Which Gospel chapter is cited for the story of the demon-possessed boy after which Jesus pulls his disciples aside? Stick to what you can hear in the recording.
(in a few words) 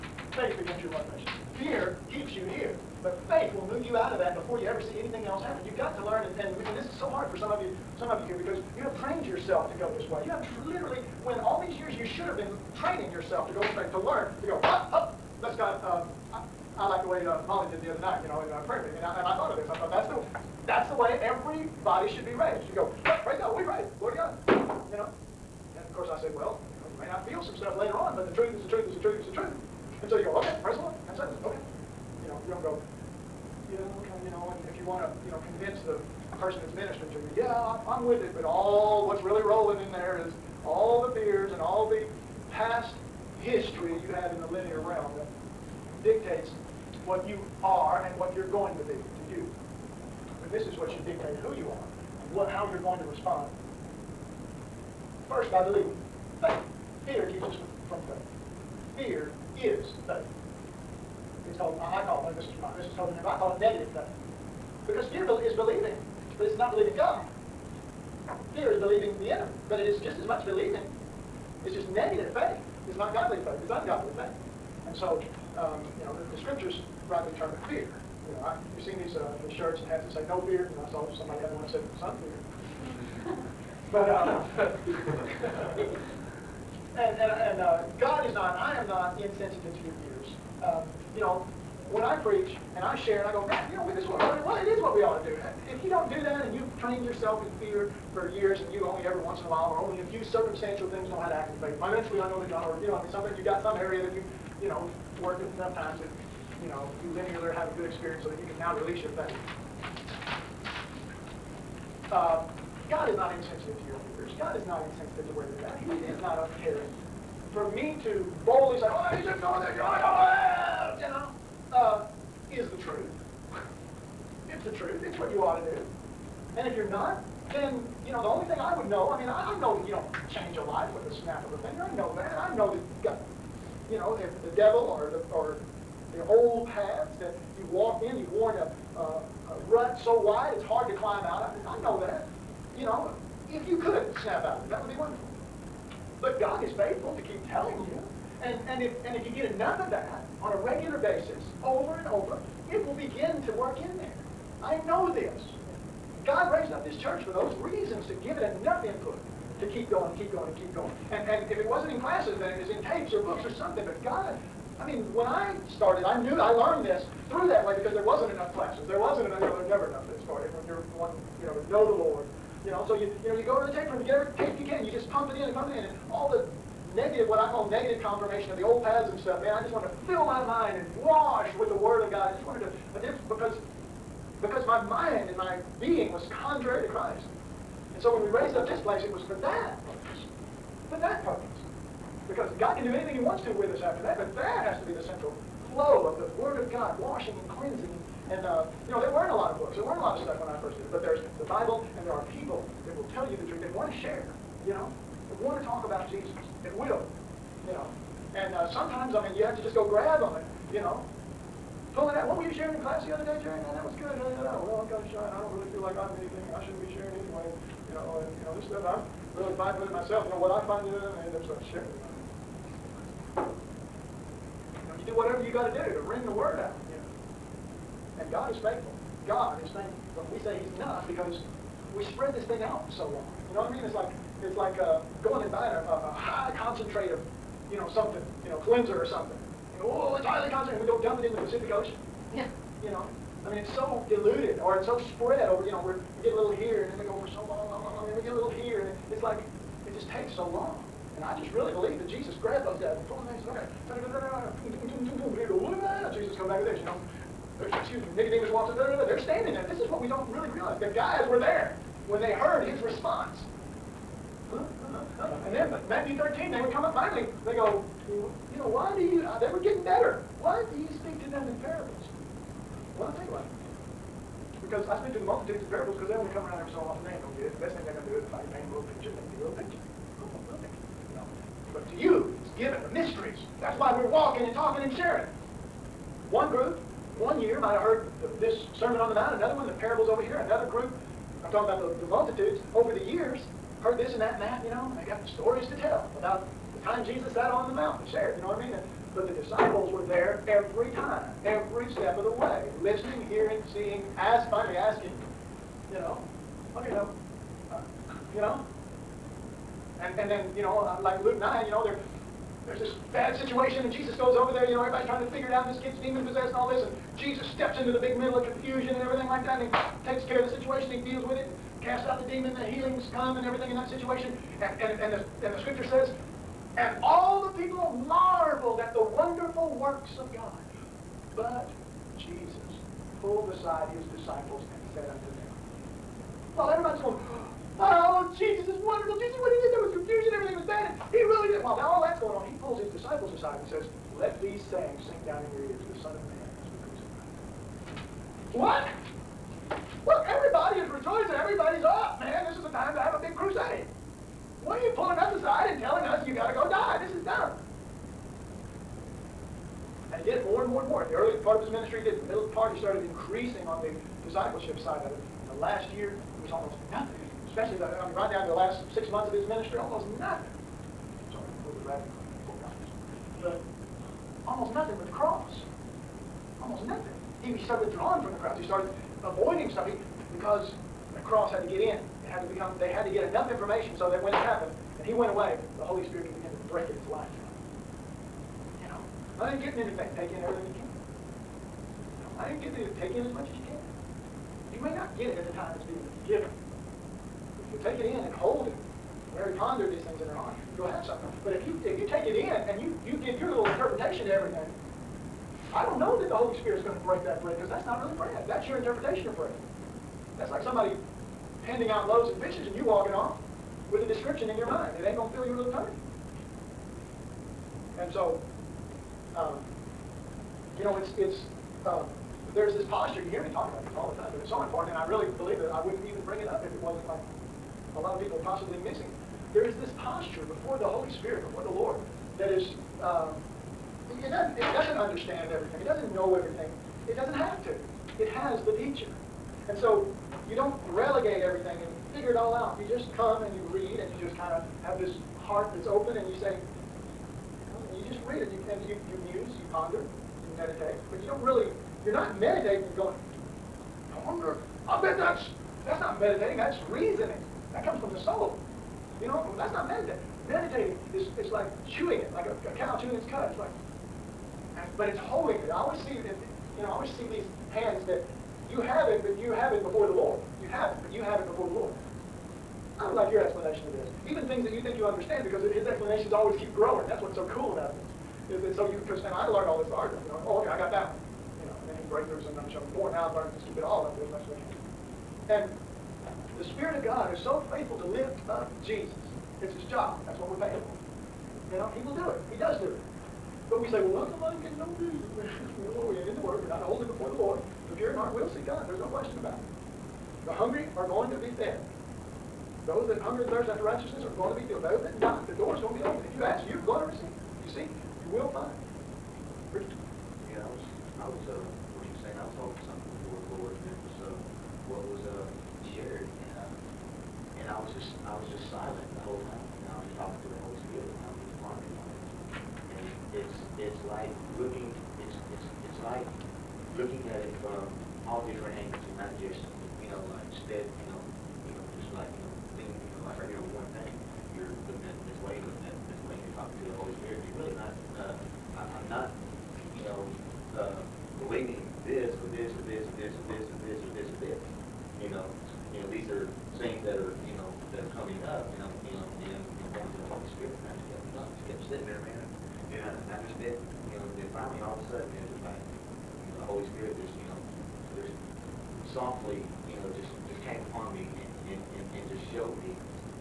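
Luke 9.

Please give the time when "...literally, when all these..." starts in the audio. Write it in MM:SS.
00:10.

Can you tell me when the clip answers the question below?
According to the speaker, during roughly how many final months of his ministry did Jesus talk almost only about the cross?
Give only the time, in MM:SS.
06:08.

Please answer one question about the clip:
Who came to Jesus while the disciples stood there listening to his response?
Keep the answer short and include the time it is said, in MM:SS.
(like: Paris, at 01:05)
Nicodemus, at 04:18.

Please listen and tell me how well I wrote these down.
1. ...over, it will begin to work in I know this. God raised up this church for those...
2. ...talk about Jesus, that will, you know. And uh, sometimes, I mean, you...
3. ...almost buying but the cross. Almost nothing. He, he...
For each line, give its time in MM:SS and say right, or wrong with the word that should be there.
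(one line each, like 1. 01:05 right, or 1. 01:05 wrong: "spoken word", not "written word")
1. 02:32 right
2. 03:25 right
3. 06:14 wrong: "nothing", not "buying".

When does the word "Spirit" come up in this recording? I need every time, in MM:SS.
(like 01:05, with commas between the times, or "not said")
06:26, 08:06.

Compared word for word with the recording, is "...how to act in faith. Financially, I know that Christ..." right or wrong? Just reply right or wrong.
wrong.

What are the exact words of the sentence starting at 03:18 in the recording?
And, uh, you know, there weren't a lot of books.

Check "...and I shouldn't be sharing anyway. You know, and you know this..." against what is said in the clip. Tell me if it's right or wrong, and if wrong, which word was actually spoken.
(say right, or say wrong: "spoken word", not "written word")
right.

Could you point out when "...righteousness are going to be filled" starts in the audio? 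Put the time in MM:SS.
08:23.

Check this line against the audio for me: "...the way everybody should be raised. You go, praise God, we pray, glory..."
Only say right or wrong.
right.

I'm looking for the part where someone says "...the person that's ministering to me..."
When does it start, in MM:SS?
00:35.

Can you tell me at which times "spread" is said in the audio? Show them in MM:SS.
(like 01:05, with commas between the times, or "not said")
03:52, 04:05.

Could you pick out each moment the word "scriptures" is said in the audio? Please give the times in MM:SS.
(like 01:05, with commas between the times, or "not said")
01:16, 05:25.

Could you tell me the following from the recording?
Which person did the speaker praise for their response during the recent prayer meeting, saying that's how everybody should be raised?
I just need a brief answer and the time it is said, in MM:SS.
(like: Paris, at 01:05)
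Molly, at 00:17.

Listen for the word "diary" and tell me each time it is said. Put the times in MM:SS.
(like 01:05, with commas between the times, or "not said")
not said.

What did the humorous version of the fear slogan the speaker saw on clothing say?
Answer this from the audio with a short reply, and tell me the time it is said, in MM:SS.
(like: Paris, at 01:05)
Some fear, at 01:21.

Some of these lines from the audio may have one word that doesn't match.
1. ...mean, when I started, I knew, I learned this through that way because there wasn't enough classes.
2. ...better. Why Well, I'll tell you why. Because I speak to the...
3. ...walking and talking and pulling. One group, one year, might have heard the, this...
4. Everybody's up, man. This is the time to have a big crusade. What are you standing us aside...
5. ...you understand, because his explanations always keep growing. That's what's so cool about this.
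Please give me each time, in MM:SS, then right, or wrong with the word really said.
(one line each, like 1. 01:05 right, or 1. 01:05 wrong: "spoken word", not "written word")
1. 02:44 right
2. 04:29 right
3. 04:44 wrong: "sharing", not "pulling"
4. 05:51 wrong: "pulling", not "standing"
5. 07:54 right.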